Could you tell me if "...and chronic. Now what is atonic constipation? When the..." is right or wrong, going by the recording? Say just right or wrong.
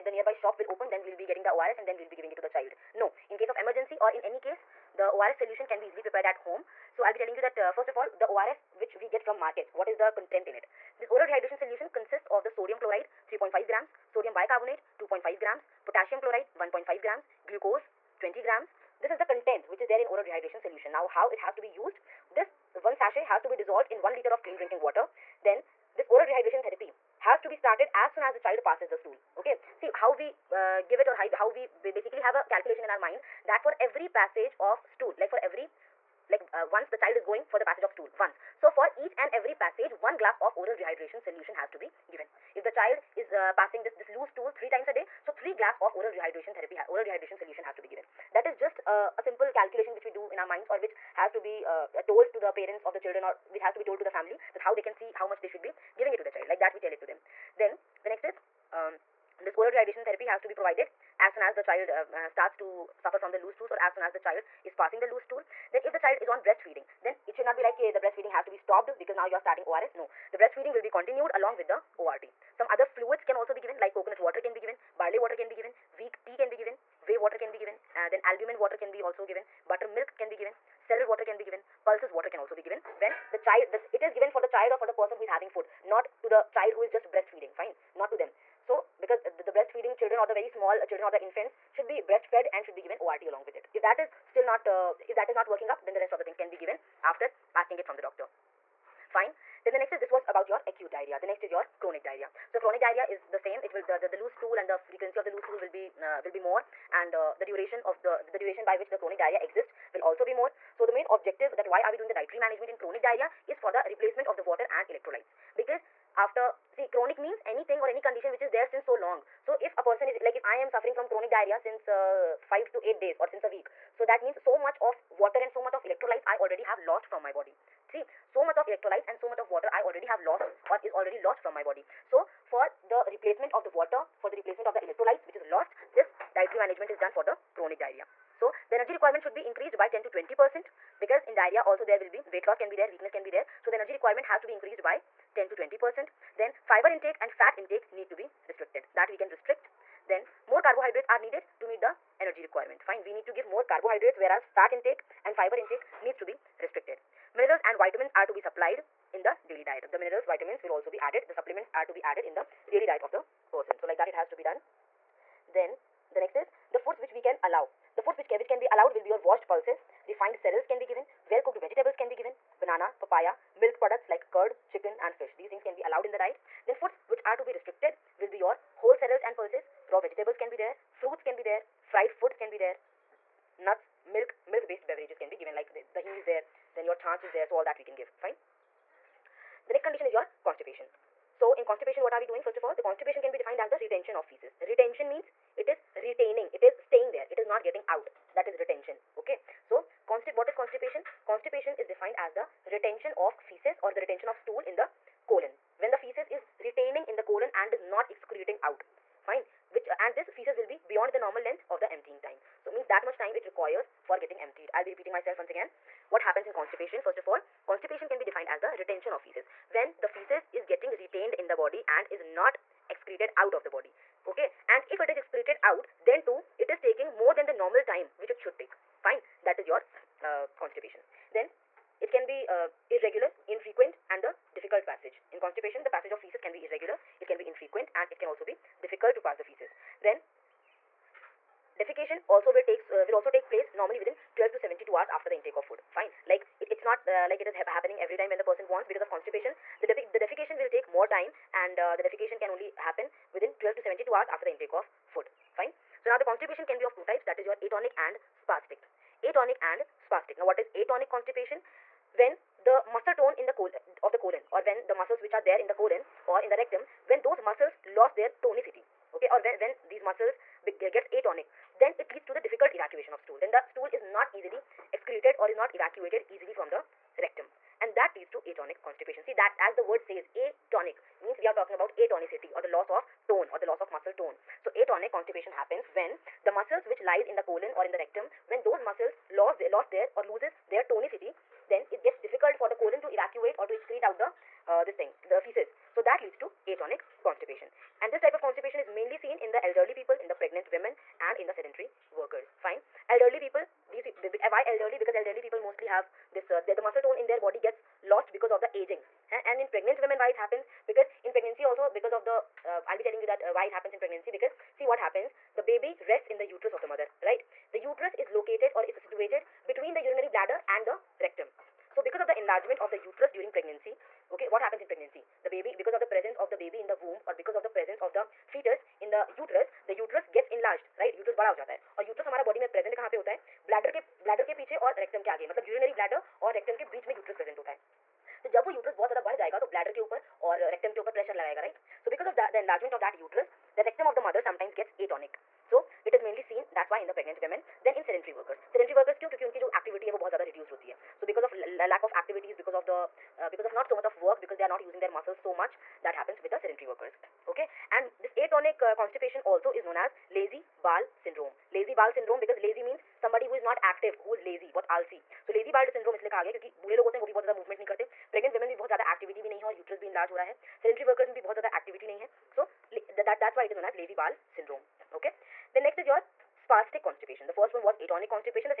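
wrong.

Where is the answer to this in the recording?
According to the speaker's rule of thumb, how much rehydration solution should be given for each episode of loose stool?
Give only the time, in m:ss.
0:39.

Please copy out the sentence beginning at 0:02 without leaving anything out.
No, in case of emergency or in any case the ORS solution can be easily prepared at home.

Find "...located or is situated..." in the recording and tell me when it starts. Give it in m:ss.
5:18.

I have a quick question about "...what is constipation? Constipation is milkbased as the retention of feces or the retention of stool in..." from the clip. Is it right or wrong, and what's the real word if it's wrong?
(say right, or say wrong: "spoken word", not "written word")
wrong: "defined", not "milkbased".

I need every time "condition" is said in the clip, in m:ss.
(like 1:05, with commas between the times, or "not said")
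1:58, 3:09.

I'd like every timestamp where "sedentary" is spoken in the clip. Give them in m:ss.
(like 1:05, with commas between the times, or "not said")
5:01, 5:56.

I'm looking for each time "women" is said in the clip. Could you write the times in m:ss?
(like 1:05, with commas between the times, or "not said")
5:00, 5:10.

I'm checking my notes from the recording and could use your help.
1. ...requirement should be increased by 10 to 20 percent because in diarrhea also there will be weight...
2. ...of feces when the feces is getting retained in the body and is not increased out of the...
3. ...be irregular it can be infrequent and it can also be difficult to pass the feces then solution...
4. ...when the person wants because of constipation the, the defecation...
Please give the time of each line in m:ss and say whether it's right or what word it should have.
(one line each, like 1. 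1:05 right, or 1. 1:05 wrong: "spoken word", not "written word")
1. 2:18 right
2. 3:39 wrong: "excreted", not "increased"
3. 3:56 wrong: "defecation", not "solution"
4. 4:08 right.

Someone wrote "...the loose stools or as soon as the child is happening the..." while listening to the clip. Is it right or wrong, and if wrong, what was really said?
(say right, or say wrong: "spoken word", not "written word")
wrong: "passing", not "happening".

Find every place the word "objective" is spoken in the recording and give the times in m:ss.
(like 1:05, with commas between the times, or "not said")
1:51.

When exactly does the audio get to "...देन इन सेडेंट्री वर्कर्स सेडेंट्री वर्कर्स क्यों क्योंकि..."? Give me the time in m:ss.
5:47.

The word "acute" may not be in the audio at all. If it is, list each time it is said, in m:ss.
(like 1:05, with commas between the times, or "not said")
1:40.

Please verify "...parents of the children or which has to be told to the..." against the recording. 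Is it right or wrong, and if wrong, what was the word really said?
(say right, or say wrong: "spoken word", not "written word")
right.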